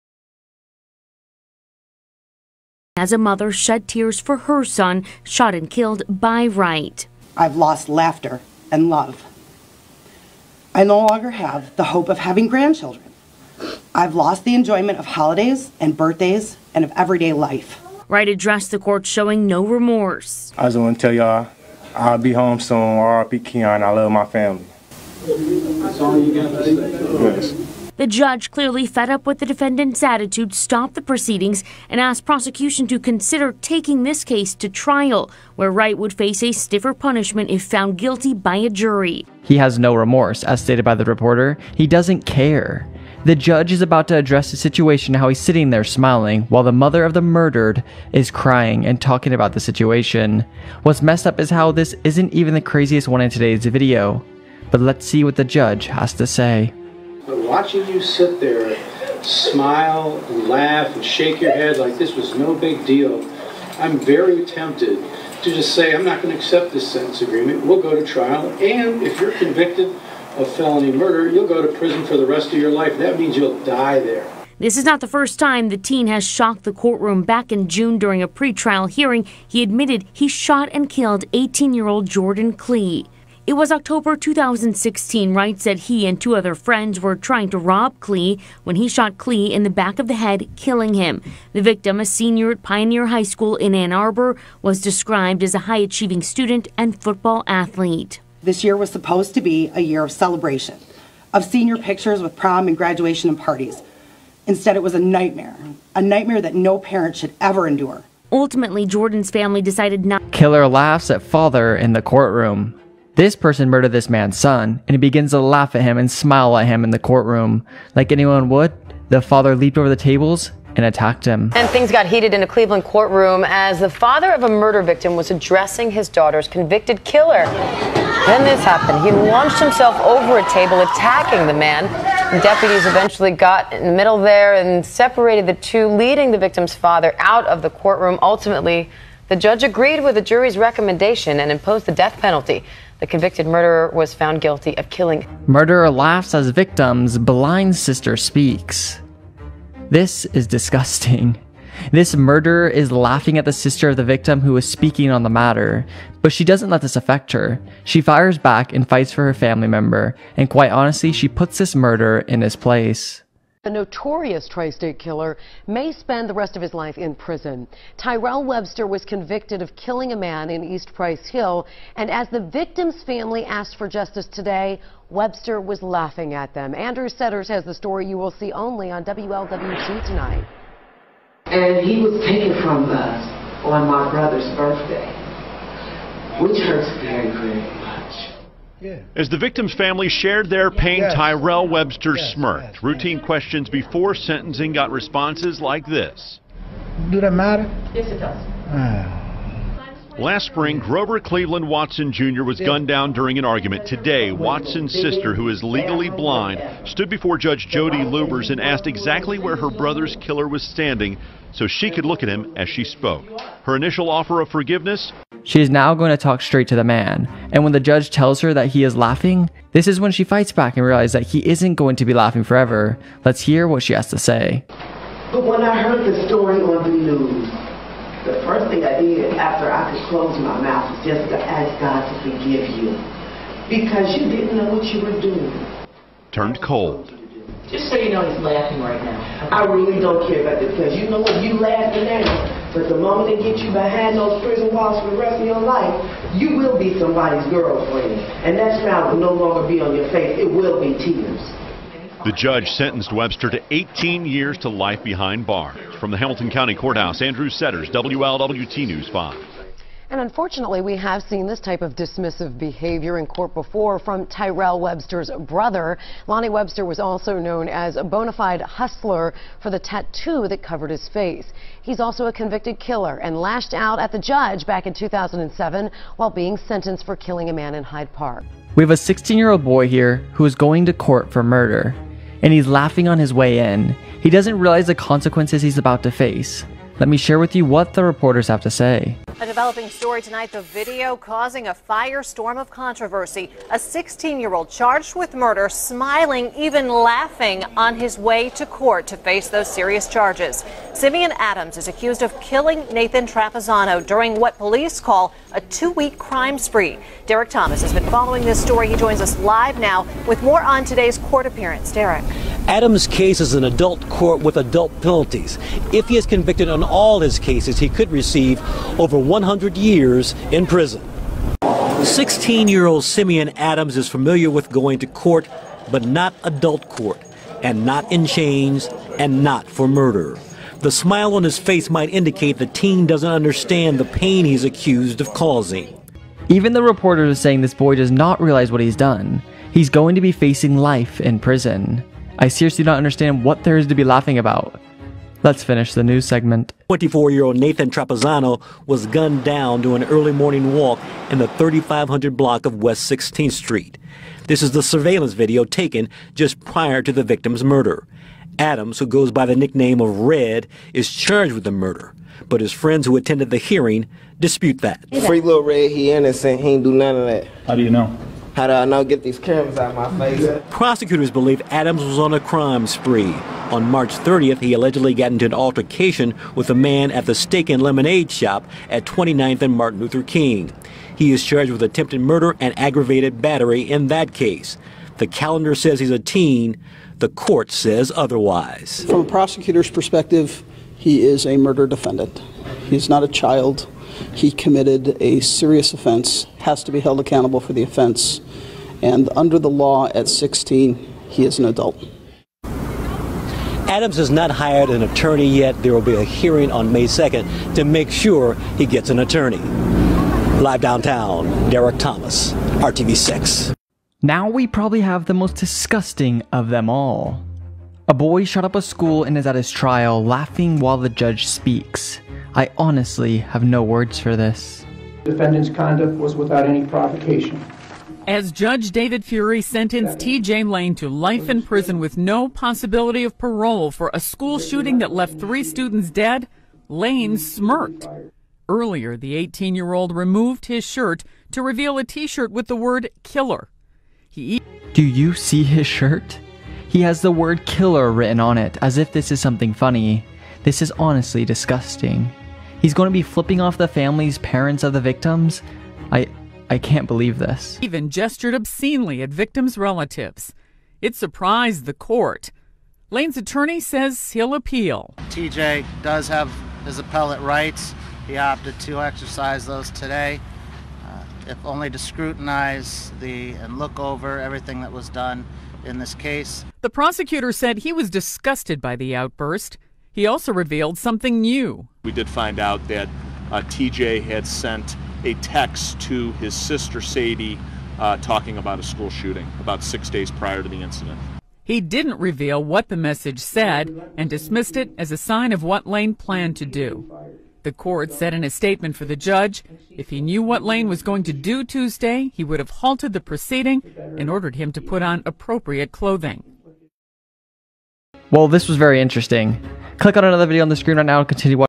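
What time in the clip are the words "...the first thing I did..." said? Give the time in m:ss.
3:48.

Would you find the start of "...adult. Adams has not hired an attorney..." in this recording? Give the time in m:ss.
6:41.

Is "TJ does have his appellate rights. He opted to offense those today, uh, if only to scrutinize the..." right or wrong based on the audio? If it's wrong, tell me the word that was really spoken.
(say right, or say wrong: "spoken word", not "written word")
wrong: "exercise", not "offense".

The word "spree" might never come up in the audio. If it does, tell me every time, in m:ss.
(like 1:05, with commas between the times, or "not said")
5:06, 6:12.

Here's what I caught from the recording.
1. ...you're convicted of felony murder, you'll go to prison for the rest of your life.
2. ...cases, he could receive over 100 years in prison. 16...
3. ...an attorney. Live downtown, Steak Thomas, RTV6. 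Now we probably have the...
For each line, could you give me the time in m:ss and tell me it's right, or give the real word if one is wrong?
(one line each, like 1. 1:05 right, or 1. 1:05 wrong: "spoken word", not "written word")
1. 1:09 right
2. 5:17 right
3. 6:49 wrong: "Derek", not "Steak".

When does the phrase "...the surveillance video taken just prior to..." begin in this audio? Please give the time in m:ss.
5:54.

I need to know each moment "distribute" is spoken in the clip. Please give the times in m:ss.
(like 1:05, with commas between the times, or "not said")
not said.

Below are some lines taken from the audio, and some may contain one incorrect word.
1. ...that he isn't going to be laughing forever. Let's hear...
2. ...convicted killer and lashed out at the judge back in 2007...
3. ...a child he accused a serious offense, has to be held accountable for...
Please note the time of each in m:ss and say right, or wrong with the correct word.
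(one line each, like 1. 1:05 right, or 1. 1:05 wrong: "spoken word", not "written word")
1. 3:41 right
2. 4:32 right
3. 6:33 wrong: "committed", not "accused".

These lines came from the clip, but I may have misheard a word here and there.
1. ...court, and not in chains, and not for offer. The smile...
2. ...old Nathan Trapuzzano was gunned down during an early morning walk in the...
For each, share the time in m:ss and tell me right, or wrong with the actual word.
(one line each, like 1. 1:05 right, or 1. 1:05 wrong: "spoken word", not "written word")
1. 5:26 wrong: "murder", not "offer"
2. 5:47 right.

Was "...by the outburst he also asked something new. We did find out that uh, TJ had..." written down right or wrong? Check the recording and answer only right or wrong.
wrong.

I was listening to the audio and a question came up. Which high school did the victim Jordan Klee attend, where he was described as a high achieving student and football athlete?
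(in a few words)
Pioneer High School.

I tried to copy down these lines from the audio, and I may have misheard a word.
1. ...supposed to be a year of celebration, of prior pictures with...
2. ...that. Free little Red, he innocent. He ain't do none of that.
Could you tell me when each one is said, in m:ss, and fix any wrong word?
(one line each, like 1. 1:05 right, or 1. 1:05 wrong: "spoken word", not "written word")
1. 1:38 wrong: "senior", not "prior"
2. 6:04 right.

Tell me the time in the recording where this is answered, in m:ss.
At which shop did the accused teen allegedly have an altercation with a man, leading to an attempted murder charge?
6:17.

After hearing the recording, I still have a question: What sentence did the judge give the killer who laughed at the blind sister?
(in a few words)
18 years to life.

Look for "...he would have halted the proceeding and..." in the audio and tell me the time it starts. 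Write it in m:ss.
8:22.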